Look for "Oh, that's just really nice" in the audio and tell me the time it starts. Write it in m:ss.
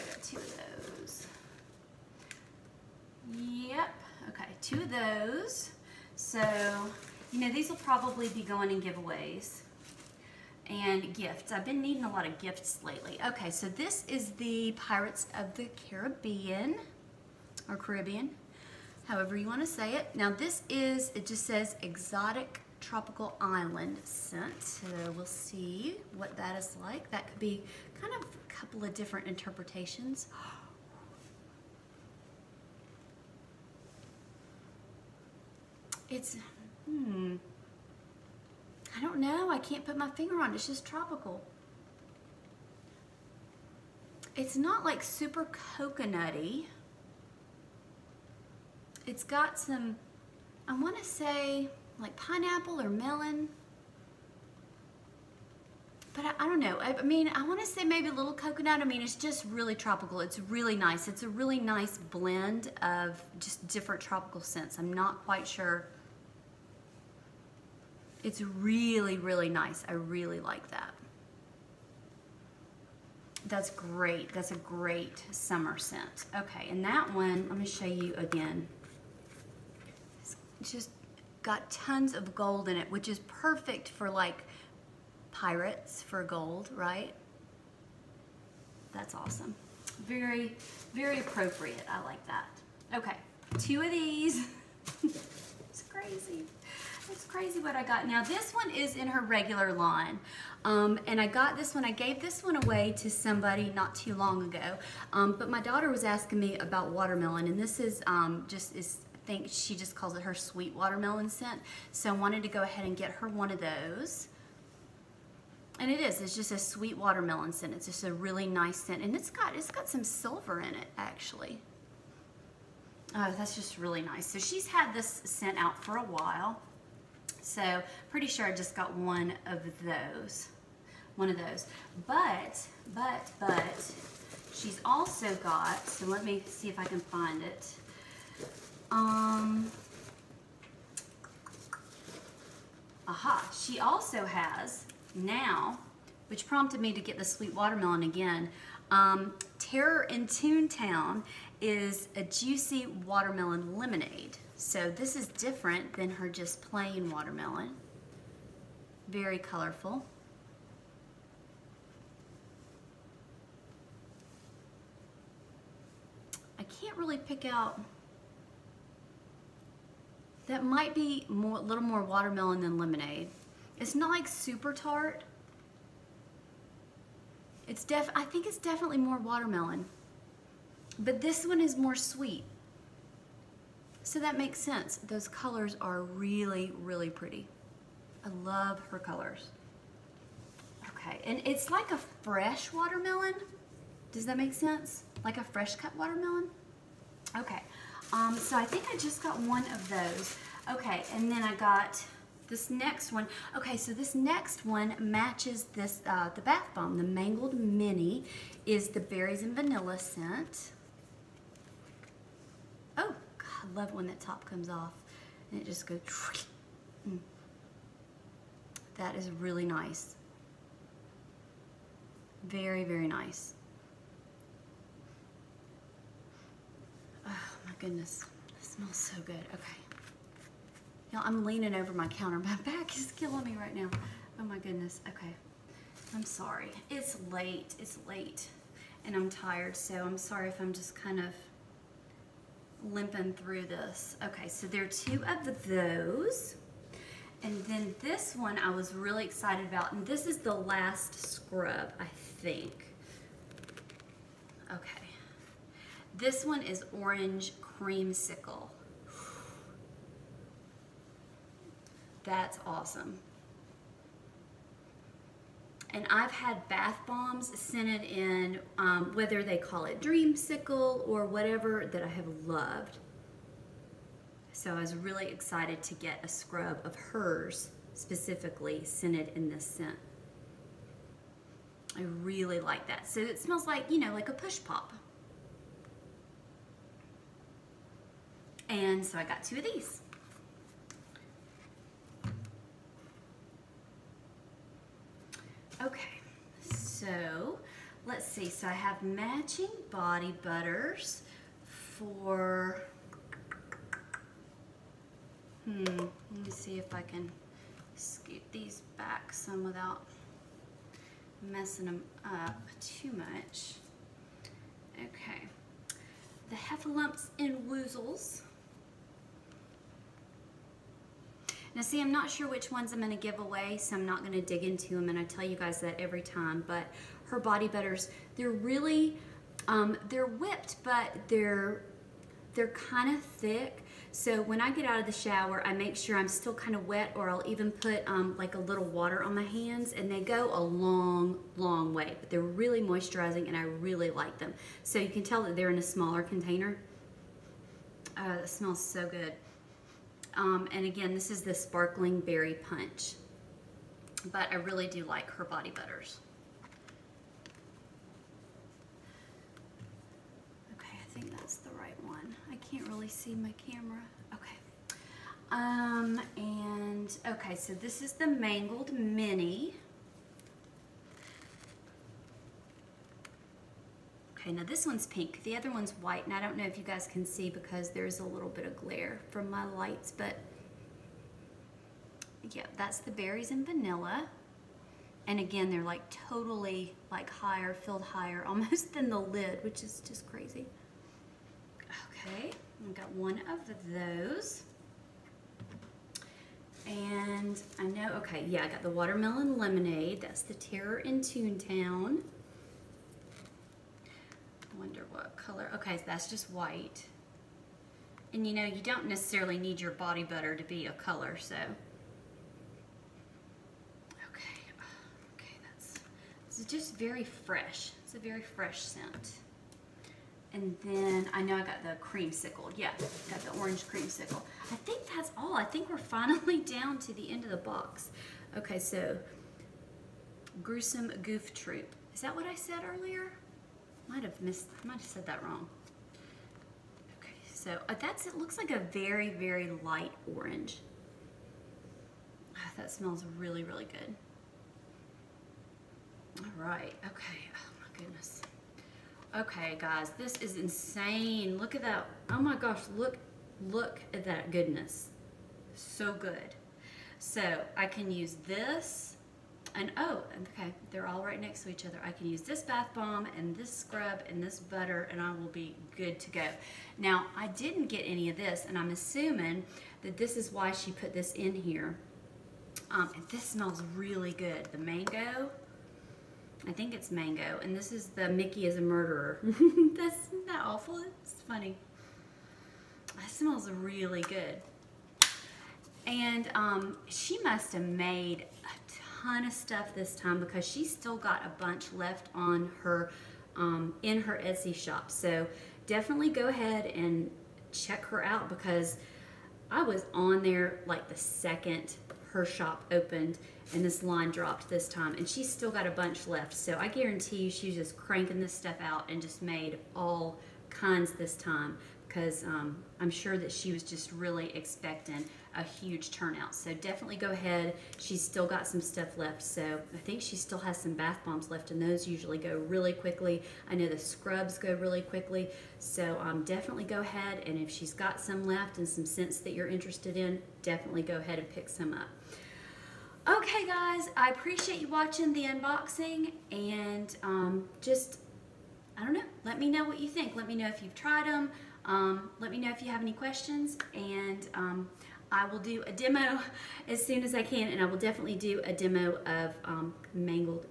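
2:03.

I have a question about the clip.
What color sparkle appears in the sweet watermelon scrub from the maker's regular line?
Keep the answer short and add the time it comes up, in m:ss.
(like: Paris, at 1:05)
silver, at 1:59.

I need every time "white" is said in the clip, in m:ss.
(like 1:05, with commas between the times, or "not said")
6:15, 6:46.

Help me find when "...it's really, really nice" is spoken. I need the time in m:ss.
1:08.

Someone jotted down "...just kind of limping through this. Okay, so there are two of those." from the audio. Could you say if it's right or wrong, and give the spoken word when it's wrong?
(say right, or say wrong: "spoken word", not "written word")
right.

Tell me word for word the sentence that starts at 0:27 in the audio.
That could be kind of a couple of different interpretations.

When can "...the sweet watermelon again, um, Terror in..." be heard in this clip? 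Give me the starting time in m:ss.
2:27.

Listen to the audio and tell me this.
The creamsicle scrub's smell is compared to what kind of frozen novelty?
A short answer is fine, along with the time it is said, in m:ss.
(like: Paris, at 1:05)
push pop, at 4:44.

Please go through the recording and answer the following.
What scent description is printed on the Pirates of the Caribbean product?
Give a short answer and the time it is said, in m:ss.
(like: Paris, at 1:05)
Exotic Tropical Island, at 0:21.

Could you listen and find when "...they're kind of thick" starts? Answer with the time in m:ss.
5:32.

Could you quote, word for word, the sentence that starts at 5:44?
So you can tell that they're in a smaller container.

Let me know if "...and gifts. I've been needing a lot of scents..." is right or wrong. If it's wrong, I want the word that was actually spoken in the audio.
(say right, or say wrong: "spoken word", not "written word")
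wrong: "gifts", not "scents".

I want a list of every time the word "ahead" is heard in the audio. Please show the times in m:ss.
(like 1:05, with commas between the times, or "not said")
1:52, 8:16, 8:37, 8:46, 8:51.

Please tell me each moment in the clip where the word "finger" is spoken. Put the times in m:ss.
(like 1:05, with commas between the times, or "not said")
0:40.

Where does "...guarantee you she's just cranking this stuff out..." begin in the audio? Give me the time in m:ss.
8:26.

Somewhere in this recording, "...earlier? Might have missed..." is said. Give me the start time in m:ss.
7:12.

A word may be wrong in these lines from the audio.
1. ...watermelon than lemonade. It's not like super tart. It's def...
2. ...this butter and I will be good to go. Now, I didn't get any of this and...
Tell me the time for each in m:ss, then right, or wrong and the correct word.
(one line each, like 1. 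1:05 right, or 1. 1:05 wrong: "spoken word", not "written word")
1. 2:52 right
2. 7:44 right.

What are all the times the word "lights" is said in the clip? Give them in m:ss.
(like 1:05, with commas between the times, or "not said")
6:19, 7:19.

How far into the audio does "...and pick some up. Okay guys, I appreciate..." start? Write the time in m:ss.
8:51.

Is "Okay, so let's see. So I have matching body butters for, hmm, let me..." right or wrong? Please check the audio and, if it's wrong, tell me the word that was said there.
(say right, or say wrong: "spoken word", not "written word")
right.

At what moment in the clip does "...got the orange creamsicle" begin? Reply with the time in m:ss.
7:03.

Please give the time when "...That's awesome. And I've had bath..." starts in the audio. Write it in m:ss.
4:22.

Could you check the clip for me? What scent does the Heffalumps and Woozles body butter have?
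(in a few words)
sparkling berry punch.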